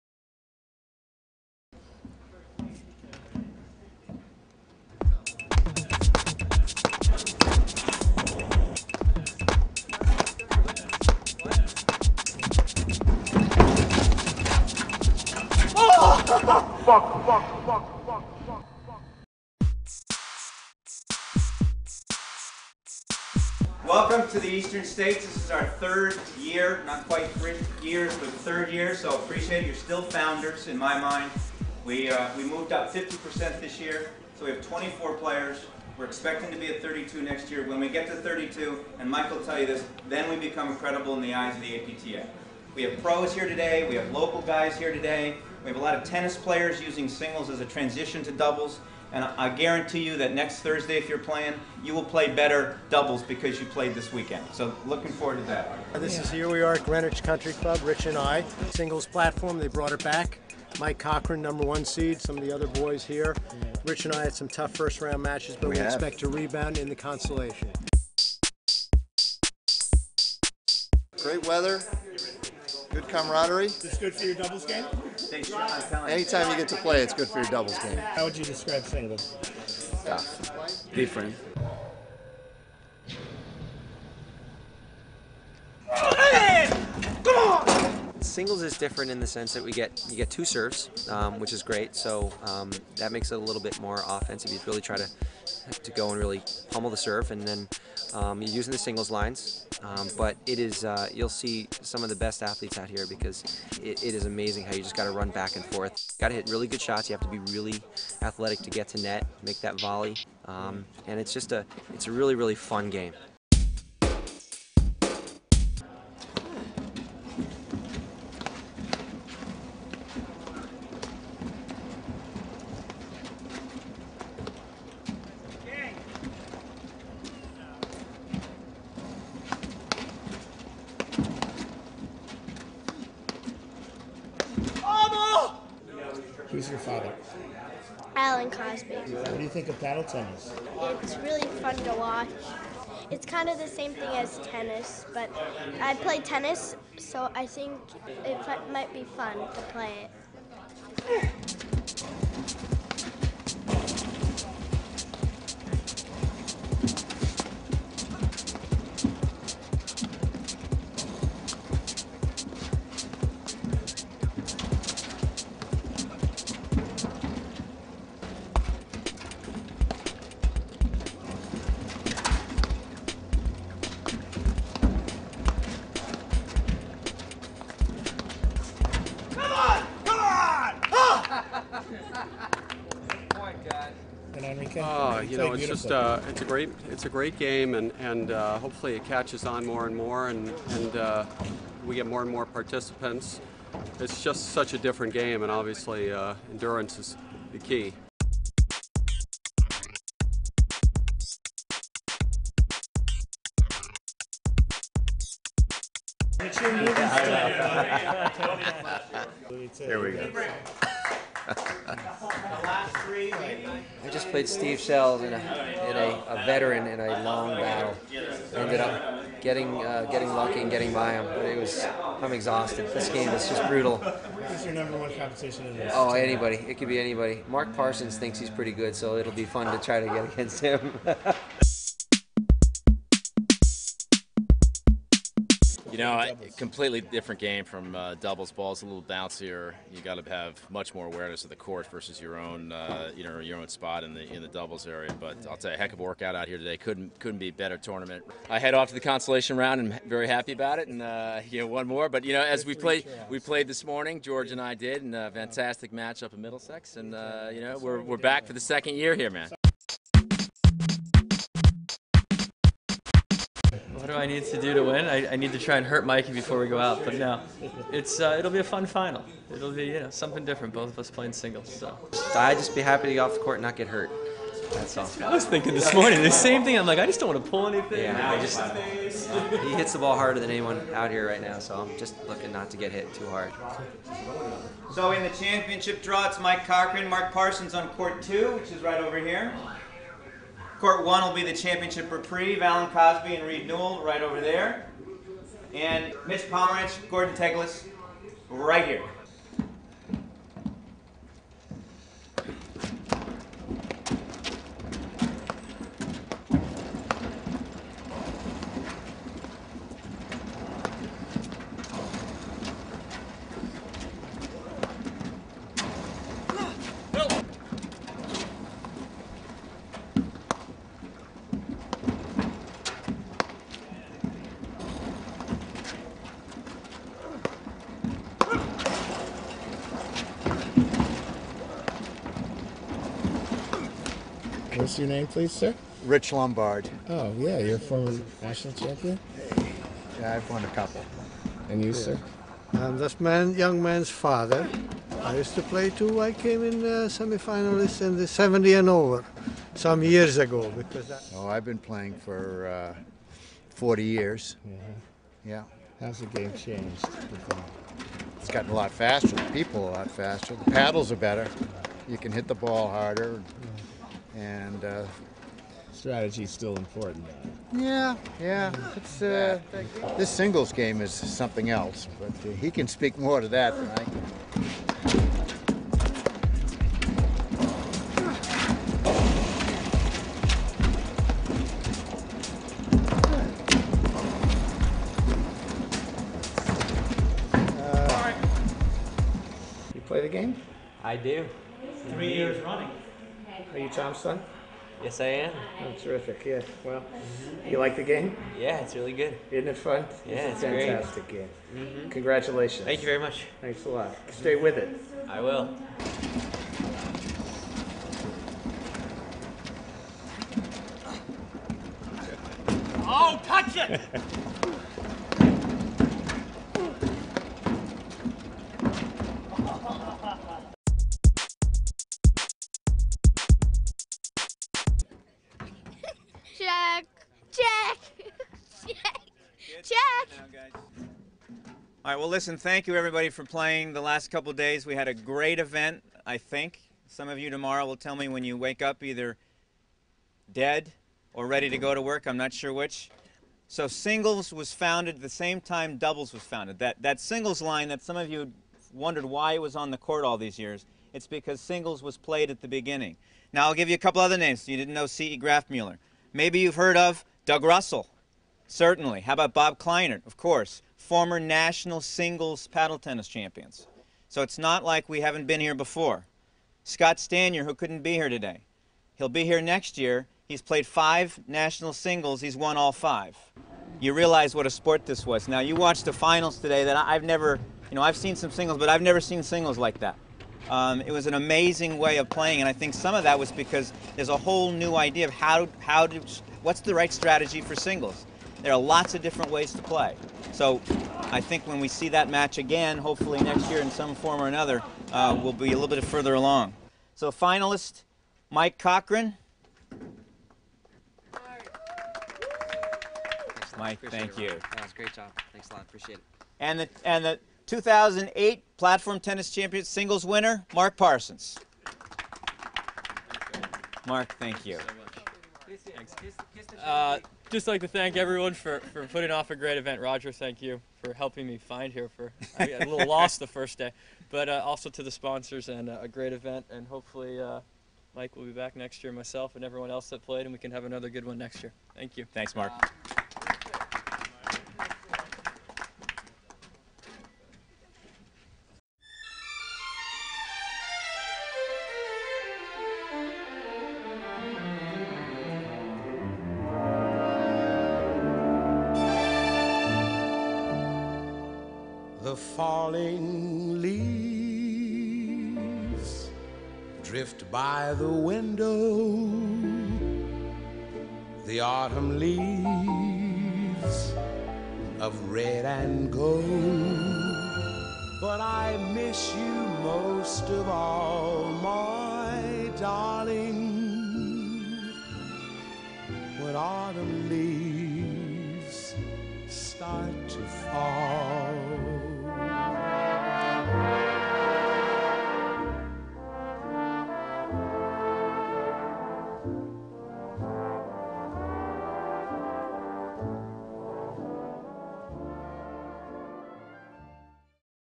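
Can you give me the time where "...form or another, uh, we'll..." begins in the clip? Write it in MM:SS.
08:14.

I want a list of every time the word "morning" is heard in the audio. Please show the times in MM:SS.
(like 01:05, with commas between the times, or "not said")
04:13, 04:35.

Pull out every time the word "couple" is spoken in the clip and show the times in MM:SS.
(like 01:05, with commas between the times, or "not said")
05:40, 07:14, 07:33.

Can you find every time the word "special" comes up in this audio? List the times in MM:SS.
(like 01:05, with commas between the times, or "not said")
not said.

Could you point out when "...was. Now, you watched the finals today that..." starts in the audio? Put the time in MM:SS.
07:55.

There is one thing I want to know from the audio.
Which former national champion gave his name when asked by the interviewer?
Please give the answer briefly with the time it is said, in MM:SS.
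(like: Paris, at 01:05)
Rich Lombard, at 05:36.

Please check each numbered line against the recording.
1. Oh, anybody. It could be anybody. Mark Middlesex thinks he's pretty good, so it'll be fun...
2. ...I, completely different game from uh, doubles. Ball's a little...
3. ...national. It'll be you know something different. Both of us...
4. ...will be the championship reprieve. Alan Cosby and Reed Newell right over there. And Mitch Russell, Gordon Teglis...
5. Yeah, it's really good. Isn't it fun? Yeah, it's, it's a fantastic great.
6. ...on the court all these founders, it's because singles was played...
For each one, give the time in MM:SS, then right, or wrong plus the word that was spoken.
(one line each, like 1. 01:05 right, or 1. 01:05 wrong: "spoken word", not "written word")
1. 03:45 wrong: "Parsons", not "Middlesex"
2. 03:56 right
3. 04:28 wrong: "final", not "national"
4. 04:51 wrong: "Pomerantz", not "Russell"
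5. 06:38 right
6. 07:29 wrong: "years", not "founders".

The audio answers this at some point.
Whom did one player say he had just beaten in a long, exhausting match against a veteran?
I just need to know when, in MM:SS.
03:34.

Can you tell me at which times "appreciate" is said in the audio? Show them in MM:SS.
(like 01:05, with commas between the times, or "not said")
00:29, 08:25.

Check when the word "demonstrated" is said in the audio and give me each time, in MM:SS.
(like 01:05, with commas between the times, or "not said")
not said.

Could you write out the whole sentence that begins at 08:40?
Roger, thank you for helping me find here.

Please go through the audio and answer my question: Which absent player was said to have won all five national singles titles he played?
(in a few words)
Scott Staniar.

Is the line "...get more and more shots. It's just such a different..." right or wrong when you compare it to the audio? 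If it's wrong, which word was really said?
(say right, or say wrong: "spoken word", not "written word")
wrong: "participants", not "shots".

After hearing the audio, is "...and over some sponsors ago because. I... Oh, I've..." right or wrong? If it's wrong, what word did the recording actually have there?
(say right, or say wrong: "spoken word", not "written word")
wrong: "years", not "sponsors".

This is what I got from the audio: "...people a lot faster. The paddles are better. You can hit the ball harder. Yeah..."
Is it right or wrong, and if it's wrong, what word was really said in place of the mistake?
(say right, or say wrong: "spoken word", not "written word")
right.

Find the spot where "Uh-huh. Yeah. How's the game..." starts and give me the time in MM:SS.
05:54.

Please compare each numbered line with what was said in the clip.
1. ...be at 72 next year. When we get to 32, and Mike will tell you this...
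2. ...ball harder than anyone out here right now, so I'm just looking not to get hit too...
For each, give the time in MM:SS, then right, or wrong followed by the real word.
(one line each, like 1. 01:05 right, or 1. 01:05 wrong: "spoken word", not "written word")
1. 00:36 wrong: "32", not "72"
2. 04:39 right.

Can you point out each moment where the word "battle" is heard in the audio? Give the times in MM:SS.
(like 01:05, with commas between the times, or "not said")
03:37.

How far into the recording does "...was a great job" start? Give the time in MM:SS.
08:24.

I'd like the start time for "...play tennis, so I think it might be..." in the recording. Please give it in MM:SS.
02:25.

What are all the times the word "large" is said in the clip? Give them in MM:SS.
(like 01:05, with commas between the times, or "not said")
not said.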